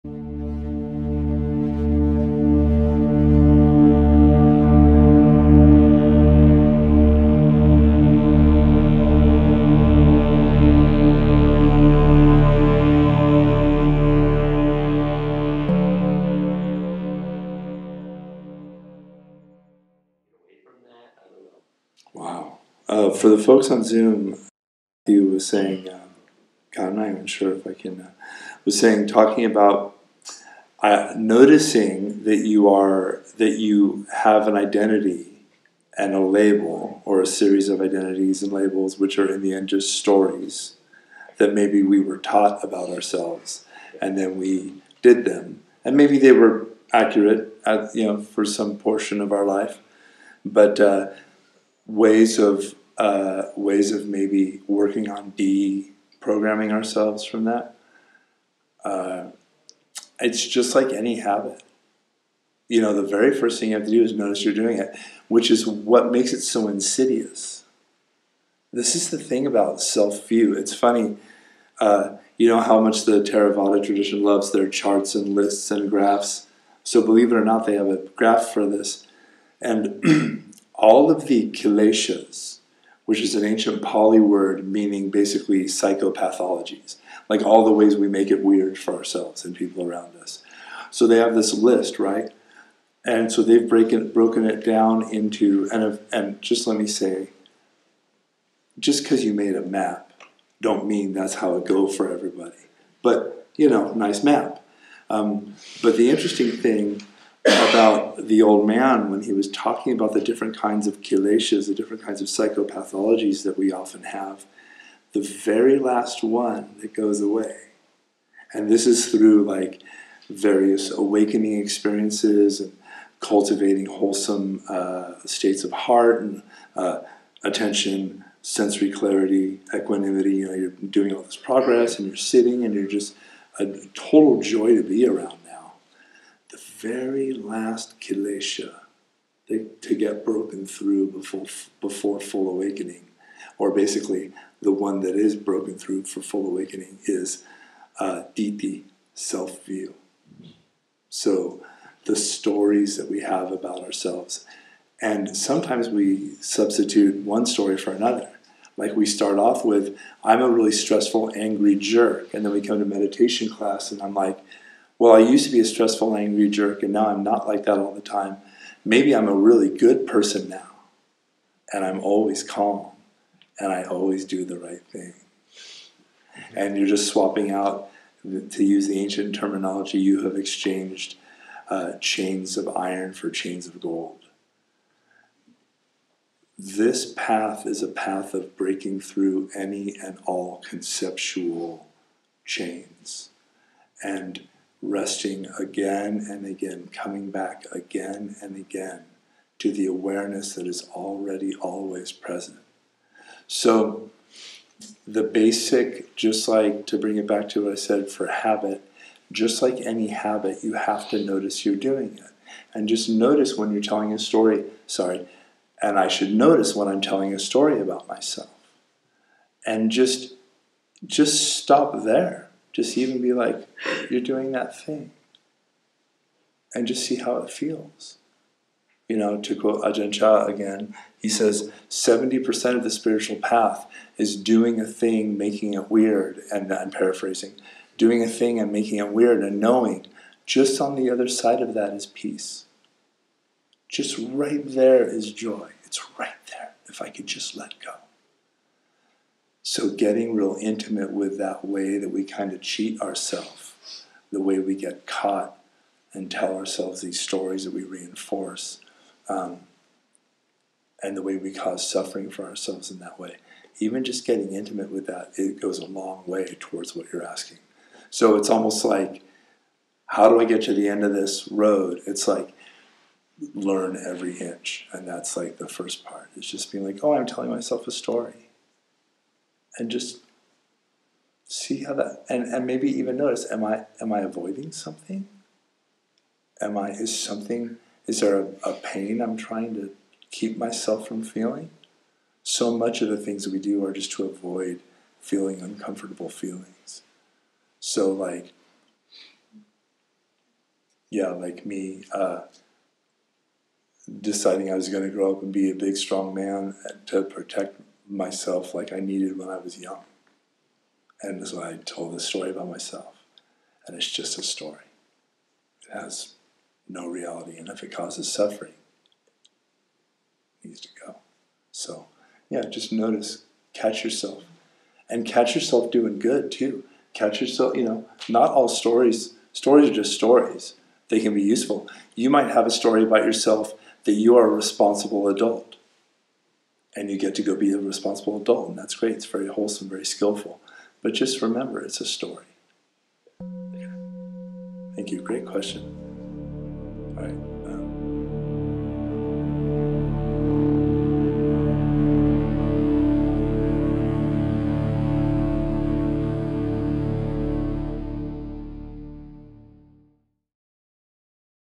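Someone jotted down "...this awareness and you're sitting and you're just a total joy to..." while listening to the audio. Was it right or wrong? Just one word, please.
wrong.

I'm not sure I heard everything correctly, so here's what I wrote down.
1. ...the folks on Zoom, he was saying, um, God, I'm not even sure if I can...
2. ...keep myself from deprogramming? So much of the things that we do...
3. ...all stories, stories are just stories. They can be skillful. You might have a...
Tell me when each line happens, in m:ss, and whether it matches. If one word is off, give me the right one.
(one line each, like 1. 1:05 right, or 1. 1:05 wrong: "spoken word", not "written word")
1. 0:23 right
2. 4:50 wrong: "feeling", not "deprogramming"
3. 5:28 wrong: "useful", not "skillful".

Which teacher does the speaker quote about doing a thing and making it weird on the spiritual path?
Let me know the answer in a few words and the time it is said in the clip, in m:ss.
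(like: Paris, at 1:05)
Ajahn Chah, at 3:49.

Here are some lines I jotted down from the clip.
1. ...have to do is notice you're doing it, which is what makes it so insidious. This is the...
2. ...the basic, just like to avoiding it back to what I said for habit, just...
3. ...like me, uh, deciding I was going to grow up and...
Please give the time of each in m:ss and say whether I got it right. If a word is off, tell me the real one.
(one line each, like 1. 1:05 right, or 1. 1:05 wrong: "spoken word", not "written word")
1. 1:03 right
2. 3:25 wrong: "bring", not "avoiding"
3. 5:01 right.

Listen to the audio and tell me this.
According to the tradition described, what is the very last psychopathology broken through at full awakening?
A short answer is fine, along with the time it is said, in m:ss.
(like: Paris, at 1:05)
ditthi, at 2:28.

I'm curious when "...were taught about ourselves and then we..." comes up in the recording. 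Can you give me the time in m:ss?
0:42.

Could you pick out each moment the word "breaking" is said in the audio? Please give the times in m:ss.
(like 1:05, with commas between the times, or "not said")
1:33, 3:08.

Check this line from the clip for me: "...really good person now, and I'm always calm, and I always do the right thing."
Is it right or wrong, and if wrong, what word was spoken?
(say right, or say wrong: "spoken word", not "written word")
right.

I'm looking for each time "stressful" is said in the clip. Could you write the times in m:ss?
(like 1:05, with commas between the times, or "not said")
2:40, 2:45.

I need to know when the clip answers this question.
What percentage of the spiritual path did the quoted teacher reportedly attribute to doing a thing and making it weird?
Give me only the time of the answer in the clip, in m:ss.
3:51.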